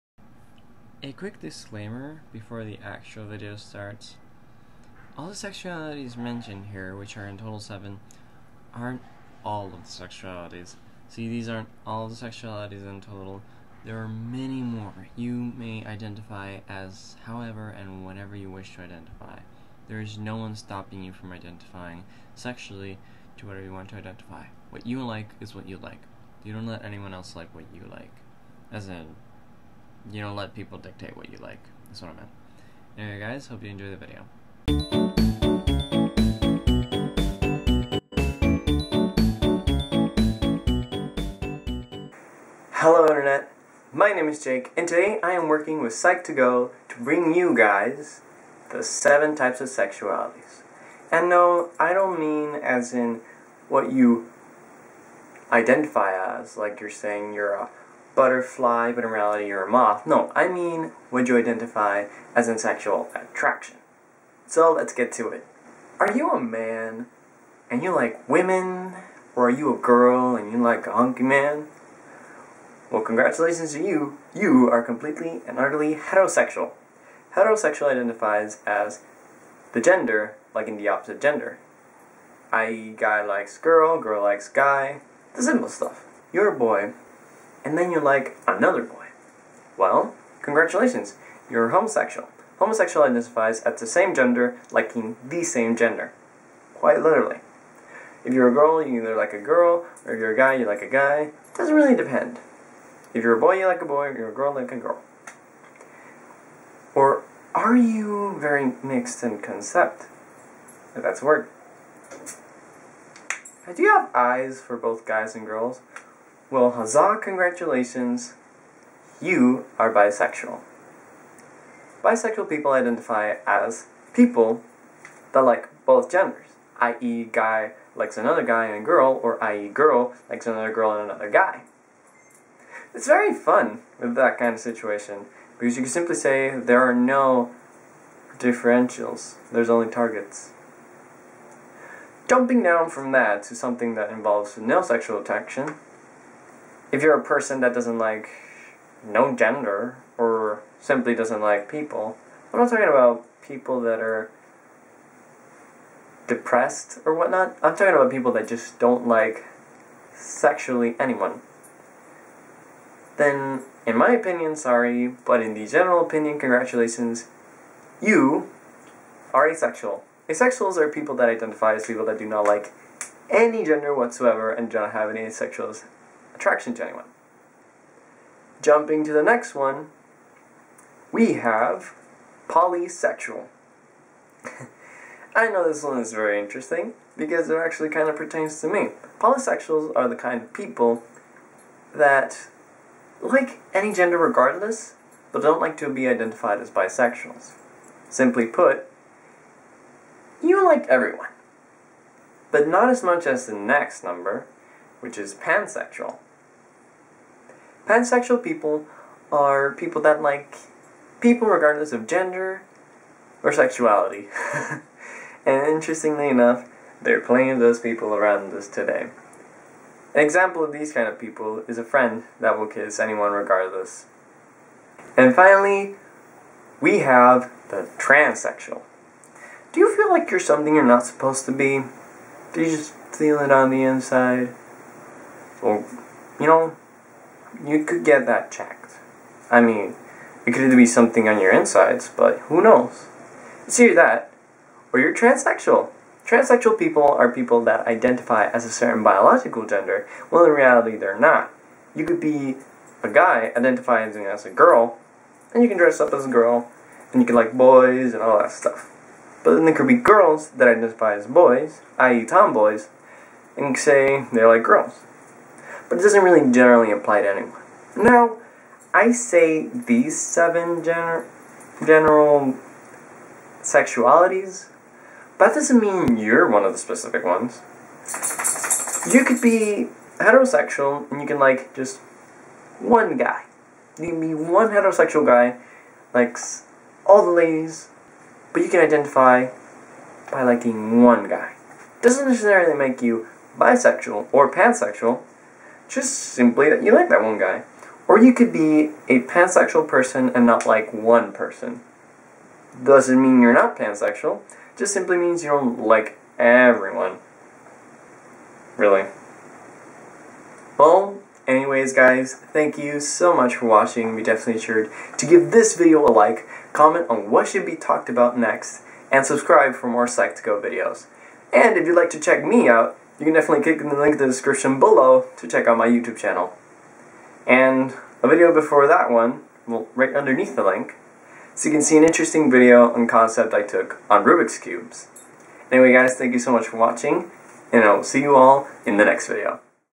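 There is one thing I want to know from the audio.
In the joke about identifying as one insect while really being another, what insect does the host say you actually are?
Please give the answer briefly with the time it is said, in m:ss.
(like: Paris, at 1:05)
moth, at 0:59.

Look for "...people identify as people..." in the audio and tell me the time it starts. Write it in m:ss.
2:02.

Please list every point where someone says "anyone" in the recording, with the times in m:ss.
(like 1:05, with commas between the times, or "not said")
0:26, 2:40, 2:56, 3:42, 4:27.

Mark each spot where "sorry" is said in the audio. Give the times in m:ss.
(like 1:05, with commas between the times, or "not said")
2:44.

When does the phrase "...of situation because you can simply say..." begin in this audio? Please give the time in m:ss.
2:14.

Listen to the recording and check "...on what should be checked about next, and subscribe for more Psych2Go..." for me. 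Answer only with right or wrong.
wrong.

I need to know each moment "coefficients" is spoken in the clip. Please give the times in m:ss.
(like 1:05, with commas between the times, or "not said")
not said.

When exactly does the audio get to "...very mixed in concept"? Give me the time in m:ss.
1:48.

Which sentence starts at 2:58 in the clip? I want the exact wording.
Jumping to the next one, we have polysexual.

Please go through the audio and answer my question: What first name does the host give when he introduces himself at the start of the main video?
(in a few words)
Jake.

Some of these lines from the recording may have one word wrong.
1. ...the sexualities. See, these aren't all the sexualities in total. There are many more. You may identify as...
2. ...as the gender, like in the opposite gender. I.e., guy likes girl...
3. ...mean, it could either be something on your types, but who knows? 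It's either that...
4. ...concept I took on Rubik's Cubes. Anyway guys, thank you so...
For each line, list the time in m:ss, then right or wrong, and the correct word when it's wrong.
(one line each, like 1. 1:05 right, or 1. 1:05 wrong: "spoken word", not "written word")
1. 0:09 right
2. 1:18 right
3. 3:59 wrong: "insides", not "types"
4. 5:33 right.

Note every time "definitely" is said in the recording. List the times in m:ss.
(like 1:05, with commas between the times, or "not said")
5:14, 5:23.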